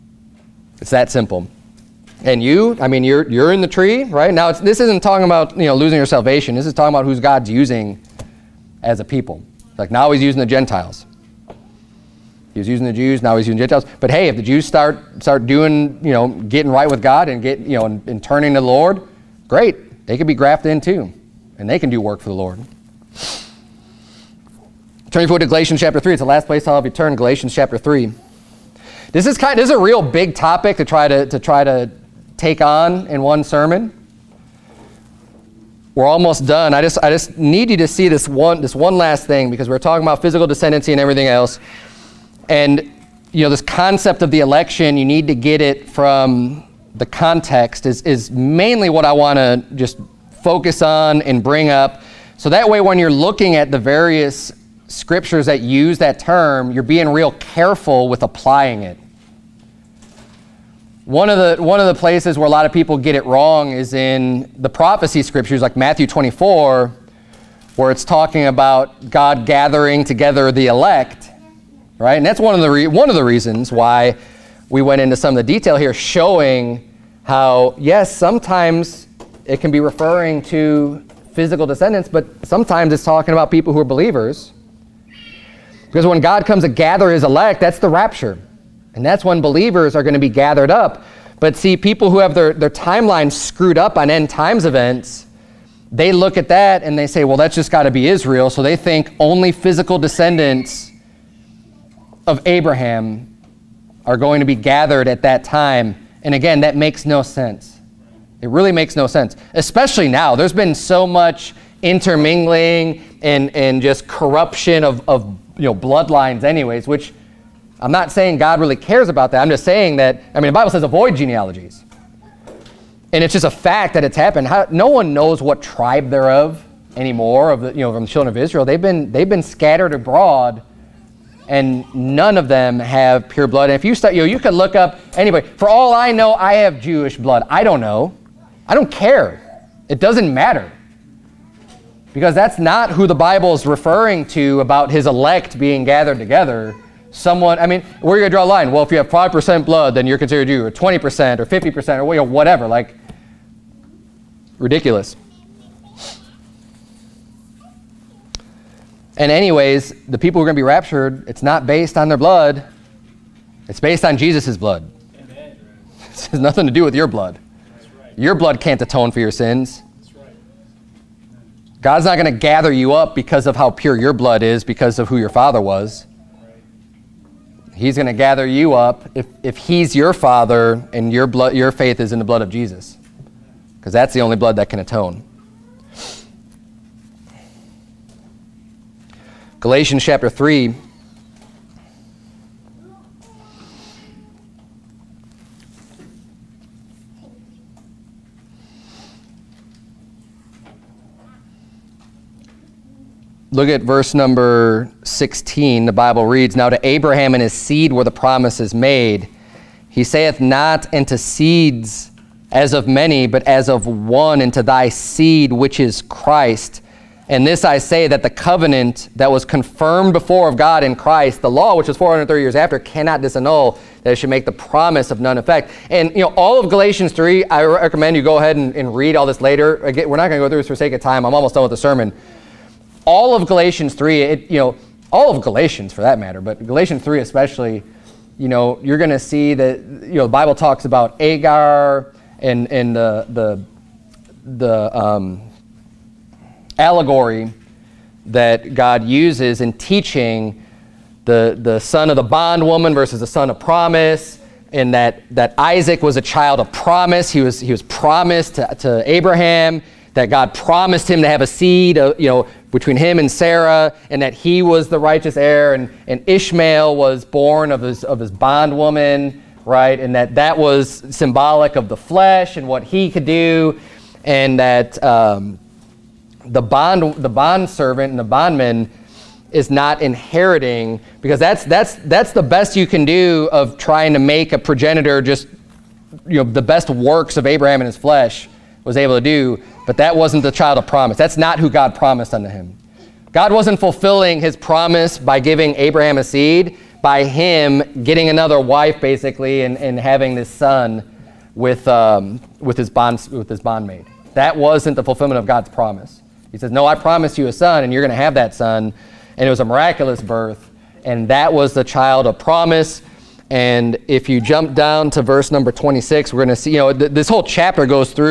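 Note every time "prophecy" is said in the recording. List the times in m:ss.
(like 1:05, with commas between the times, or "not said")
1:04.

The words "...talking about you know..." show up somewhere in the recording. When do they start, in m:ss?
0:05.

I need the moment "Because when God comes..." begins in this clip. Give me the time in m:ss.
1:25.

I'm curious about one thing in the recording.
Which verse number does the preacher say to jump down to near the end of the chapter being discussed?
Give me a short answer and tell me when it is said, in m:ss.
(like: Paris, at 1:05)
26, at 5:15.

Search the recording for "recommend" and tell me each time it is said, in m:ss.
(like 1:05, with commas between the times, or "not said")
3:47.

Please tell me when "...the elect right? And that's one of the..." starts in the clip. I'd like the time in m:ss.
1:10.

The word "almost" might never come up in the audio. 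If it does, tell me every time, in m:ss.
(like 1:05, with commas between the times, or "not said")
0:36, 3:51.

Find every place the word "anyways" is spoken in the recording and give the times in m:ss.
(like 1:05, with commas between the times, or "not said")
1:56, 2:39.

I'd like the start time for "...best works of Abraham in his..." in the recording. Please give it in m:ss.
4:46.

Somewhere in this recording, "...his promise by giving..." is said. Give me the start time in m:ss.
4:54.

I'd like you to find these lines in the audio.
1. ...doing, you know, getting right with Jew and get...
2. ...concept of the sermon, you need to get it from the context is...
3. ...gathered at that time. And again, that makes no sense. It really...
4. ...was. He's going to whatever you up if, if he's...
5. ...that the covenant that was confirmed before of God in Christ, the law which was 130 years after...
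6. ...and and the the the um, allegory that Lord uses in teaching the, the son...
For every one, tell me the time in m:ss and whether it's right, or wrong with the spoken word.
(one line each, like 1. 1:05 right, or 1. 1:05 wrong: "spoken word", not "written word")
1. 0:15 wrong: "God", not "Jew"
2. 0:43 wrong: "election", not "sermon"
3. 1:44 right
4. 2:55 wrong: "gather", not "whatever"
5. 3:38 wrong: "430", not "130"
6. 4:02 wrong: "God", not "Lord".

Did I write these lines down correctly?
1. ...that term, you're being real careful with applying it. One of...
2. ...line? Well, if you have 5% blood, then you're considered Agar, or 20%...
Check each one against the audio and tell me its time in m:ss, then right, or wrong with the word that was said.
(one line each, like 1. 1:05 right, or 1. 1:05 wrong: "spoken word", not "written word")
1. 0:55 right
2. 2:28 wrong: "Jew", not "Agar".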